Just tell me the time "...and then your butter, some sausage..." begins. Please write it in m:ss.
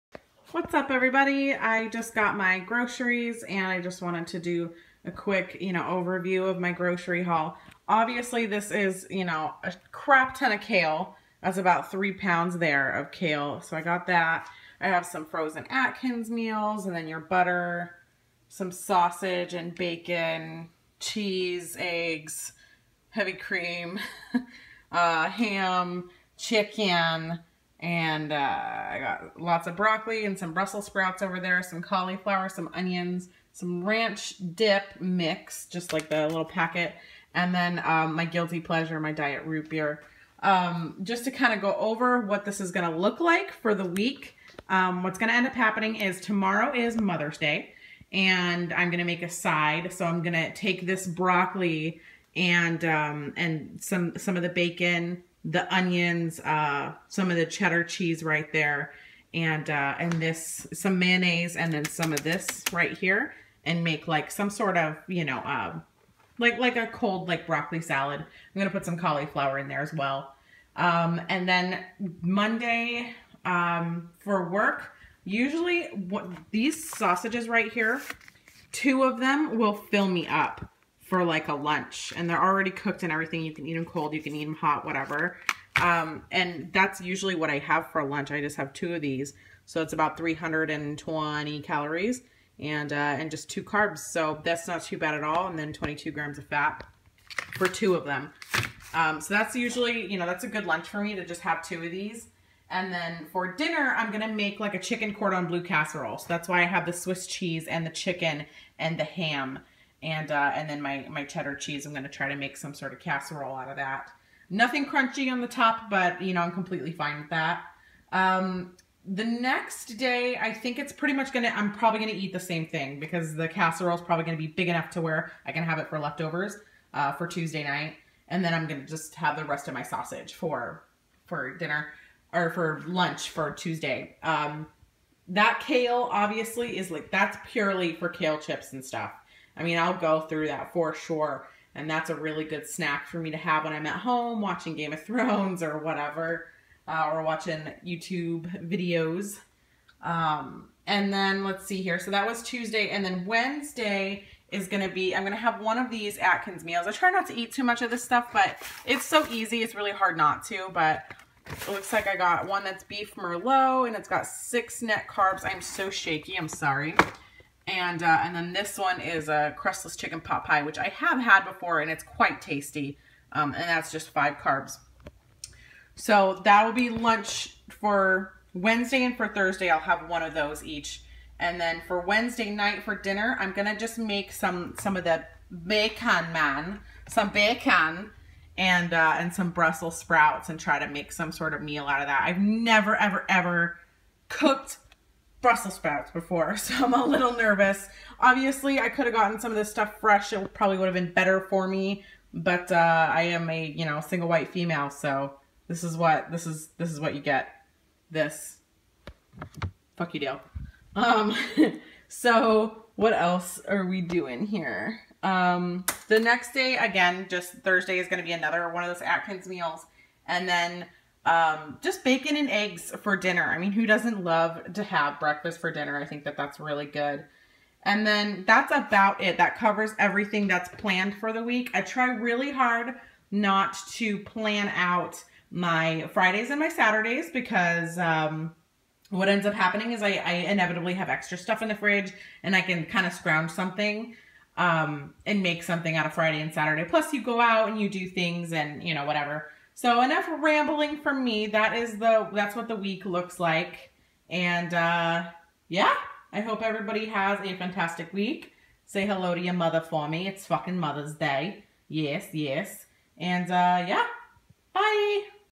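0:16.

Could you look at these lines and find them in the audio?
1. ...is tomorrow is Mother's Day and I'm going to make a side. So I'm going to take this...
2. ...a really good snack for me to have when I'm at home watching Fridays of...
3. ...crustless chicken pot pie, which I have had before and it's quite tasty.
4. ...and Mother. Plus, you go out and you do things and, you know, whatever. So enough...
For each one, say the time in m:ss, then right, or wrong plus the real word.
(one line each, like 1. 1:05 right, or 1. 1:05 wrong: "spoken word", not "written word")
1. 0:45 right
2. 2:22 wrong: "Game", not "Fridays"
3. 2:49 right
4. 4:06 wrong: "Saturday", not "Mother".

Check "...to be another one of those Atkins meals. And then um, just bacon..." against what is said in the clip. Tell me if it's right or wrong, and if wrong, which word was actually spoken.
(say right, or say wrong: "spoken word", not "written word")
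right.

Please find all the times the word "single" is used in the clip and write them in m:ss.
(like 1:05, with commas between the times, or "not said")
3:23.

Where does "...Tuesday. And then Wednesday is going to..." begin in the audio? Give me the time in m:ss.
2:32.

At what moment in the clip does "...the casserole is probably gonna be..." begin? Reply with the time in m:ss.
2:03.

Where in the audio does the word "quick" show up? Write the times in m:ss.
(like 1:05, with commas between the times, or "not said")
0:05.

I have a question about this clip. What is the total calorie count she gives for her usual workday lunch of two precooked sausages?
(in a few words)
320.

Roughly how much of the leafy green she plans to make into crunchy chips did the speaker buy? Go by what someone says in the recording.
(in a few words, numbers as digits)
3 pounds.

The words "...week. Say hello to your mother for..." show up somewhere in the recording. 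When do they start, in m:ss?
4:18.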